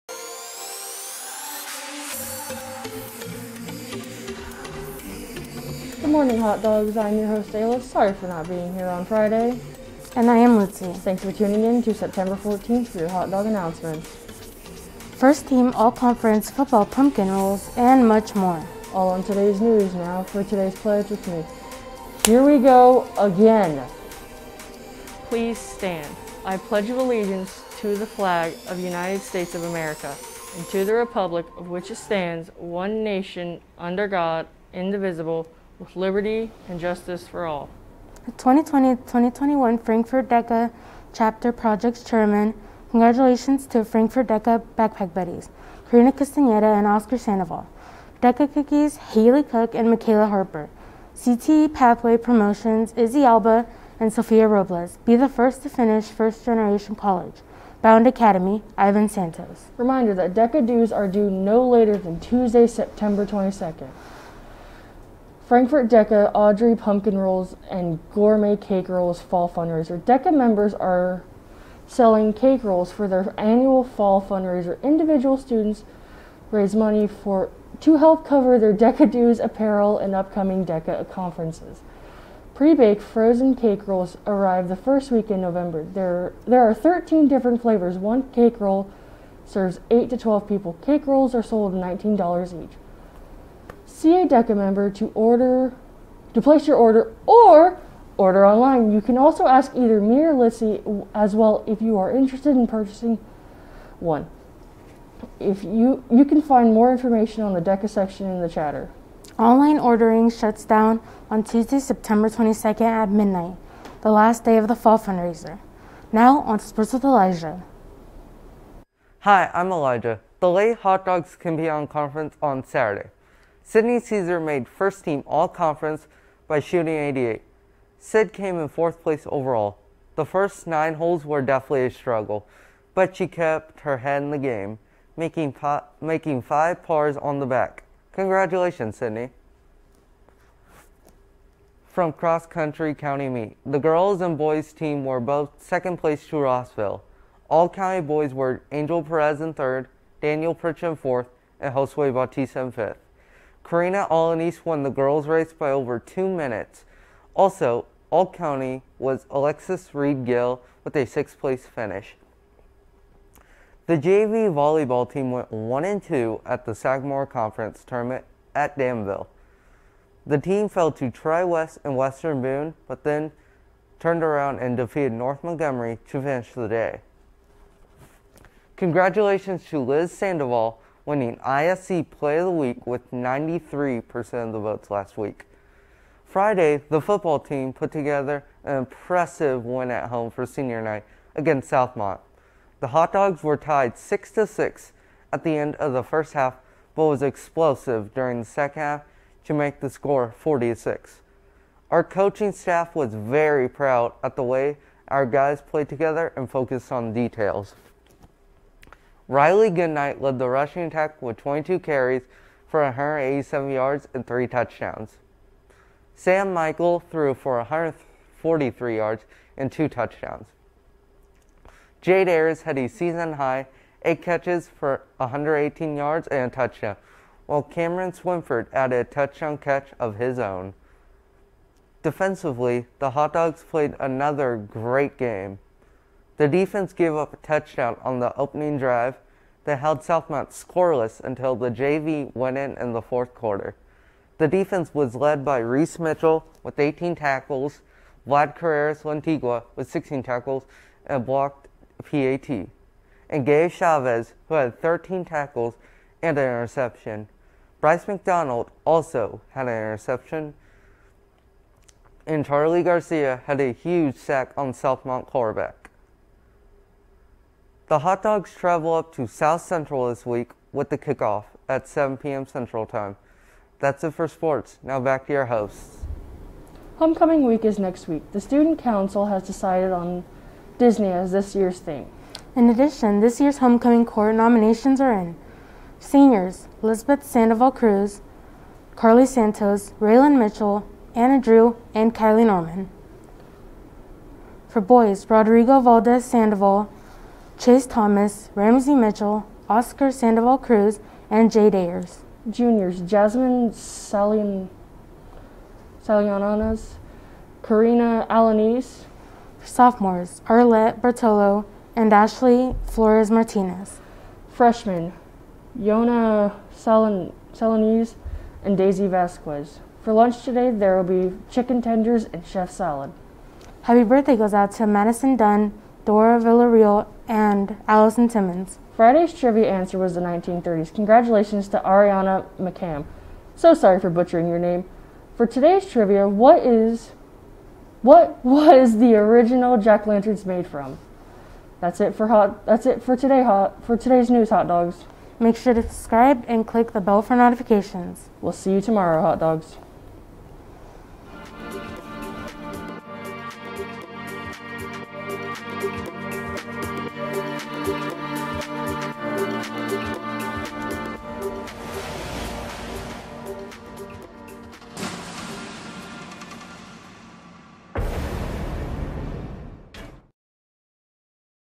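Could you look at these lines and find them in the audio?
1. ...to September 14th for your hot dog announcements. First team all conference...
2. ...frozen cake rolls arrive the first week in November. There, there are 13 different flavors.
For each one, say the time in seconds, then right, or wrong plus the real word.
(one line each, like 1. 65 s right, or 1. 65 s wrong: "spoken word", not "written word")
1. 11 s right
2. 83 s right.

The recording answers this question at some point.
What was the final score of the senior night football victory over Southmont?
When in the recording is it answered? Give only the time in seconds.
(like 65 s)
200 s.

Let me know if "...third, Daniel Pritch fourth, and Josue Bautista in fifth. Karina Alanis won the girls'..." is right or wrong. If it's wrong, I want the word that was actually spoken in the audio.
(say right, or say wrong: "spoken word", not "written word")
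right.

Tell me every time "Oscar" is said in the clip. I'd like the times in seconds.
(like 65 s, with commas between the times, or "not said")
46 s, 299 s.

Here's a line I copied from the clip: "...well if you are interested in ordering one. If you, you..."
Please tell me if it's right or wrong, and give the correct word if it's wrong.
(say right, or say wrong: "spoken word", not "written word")
wrong: "purchasing", not "ordering".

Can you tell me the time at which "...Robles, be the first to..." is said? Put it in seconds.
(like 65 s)
54 s.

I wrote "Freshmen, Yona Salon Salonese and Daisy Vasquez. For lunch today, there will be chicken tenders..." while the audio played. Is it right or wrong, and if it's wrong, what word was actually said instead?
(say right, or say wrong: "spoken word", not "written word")
right.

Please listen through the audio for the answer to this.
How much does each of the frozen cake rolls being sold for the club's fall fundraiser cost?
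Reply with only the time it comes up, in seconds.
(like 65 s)
91 s.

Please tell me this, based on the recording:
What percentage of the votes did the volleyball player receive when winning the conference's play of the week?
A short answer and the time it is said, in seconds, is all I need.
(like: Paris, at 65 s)
93%, at 183 s.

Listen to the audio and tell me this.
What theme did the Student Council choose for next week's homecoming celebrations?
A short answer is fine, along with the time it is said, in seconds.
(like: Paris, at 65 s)
Disney, at 280 s.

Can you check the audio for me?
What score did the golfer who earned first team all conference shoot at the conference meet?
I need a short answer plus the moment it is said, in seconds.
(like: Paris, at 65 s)
88, at 126 s.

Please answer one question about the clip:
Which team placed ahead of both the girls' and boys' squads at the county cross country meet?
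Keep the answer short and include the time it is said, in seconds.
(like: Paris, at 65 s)
Rossville, at 146 s.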